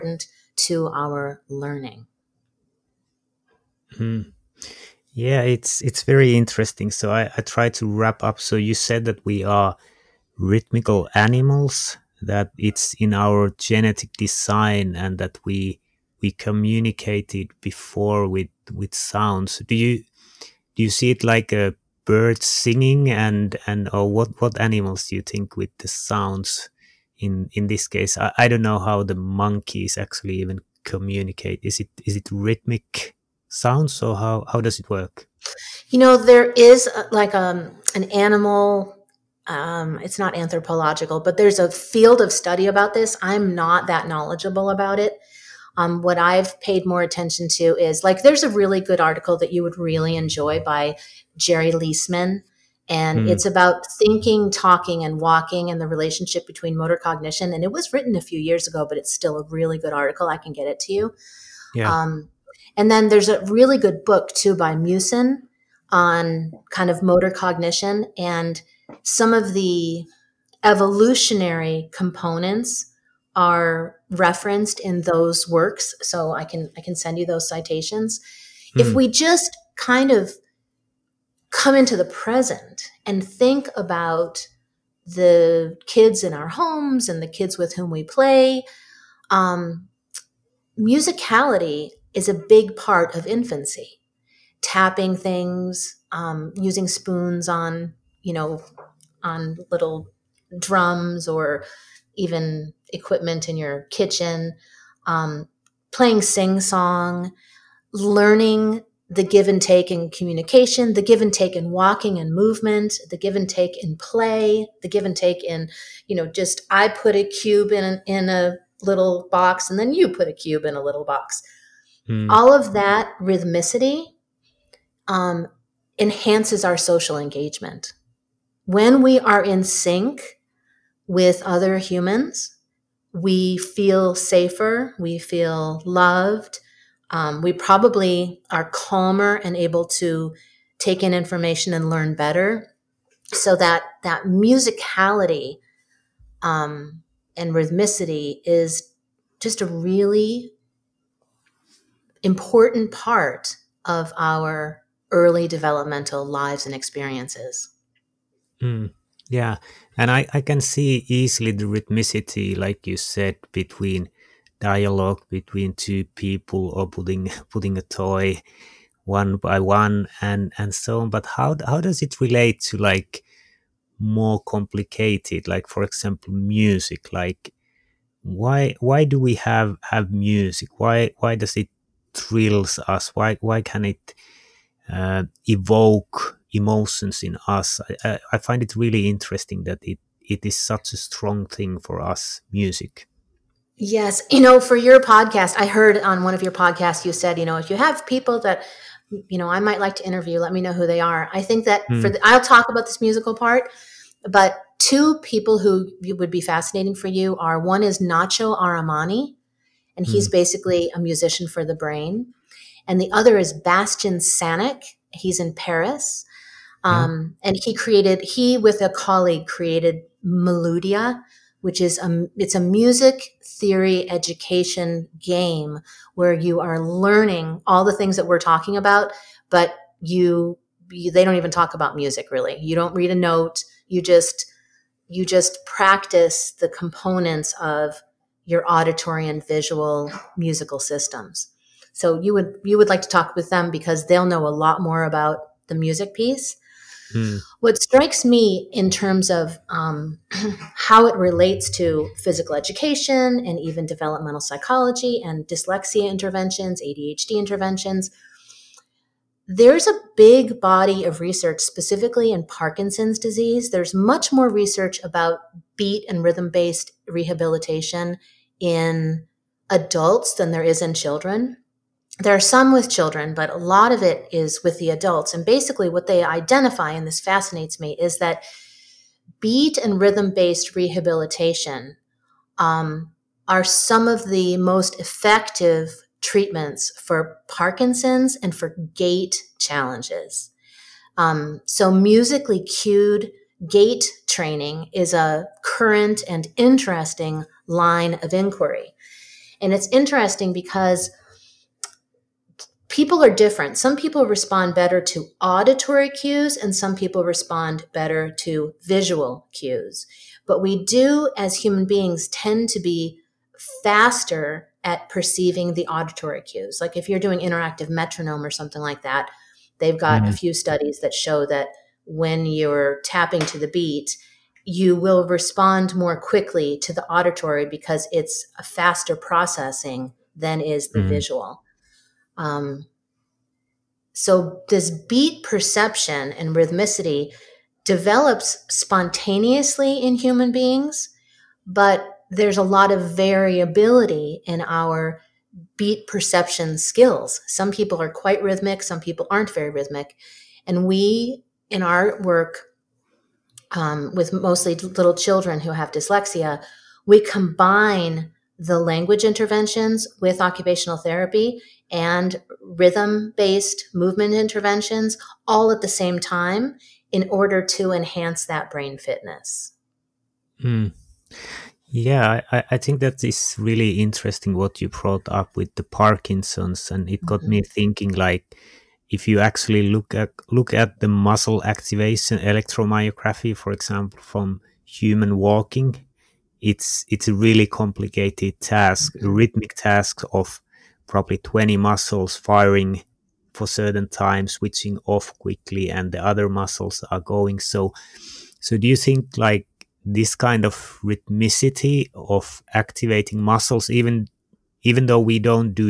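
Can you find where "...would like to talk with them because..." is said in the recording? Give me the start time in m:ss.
4:02.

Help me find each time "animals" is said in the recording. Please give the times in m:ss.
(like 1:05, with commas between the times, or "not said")
0:11, 0:24, 0:38.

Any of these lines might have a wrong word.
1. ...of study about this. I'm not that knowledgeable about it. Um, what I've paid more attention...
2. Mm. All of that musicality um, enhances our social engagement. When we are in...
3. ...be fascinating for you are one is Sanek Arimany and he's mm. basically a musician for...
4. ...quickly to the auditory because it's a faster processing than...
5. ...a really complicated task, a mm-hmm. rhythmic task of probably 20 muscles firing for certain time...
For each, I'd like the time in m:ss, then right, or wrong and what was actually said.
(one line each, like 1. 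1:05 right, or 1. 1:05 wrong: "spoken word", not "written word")
1. 0:42 right
2. 2:02 wrong: "rhythmicity", not "musicality"
3. 3:26 wrong: "Nacho", not "Sanek"
4. 5:26 right
5. 6:27 right.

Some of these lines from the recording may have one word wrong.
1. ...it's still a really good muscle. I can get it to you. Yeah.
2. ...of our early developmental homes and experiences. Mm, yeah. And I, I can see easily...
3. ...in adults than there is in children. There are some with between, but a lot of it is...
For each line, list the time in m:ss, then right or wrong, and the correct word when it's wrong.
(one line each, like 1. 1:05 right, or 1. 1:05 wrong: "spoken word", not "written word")
1. 0:58 wrong: "article", not "muscle"
2. 2:33 wrong: "lives", not "homes"
3. 4:28 wrong: "children", not "between".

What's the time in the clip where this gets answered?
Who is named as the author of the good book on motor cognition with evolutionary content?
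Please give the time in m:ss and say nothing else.
1:04.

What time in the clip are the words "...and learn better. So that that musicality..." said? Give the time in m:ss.
2:21.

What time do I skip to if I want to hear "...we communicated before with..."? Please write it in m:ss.
0:16.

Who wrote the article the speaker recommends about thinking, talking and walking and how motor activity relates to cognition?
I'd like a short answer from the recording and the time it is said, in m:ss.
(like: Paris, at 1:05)
Gerry Leisman, at 0:51.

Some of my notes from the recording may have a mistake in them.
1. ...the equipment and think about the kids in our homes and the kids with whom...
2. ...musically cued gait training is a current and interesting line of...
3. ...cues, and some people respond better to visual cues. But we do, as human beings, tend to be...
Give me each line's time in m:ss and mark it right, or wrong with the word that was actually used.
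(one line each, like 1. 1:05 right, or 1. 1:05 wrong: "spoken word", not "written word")
1. 1:21 wrong: "present", not "equipment"
2. 4:51 right
3. 5:06 right.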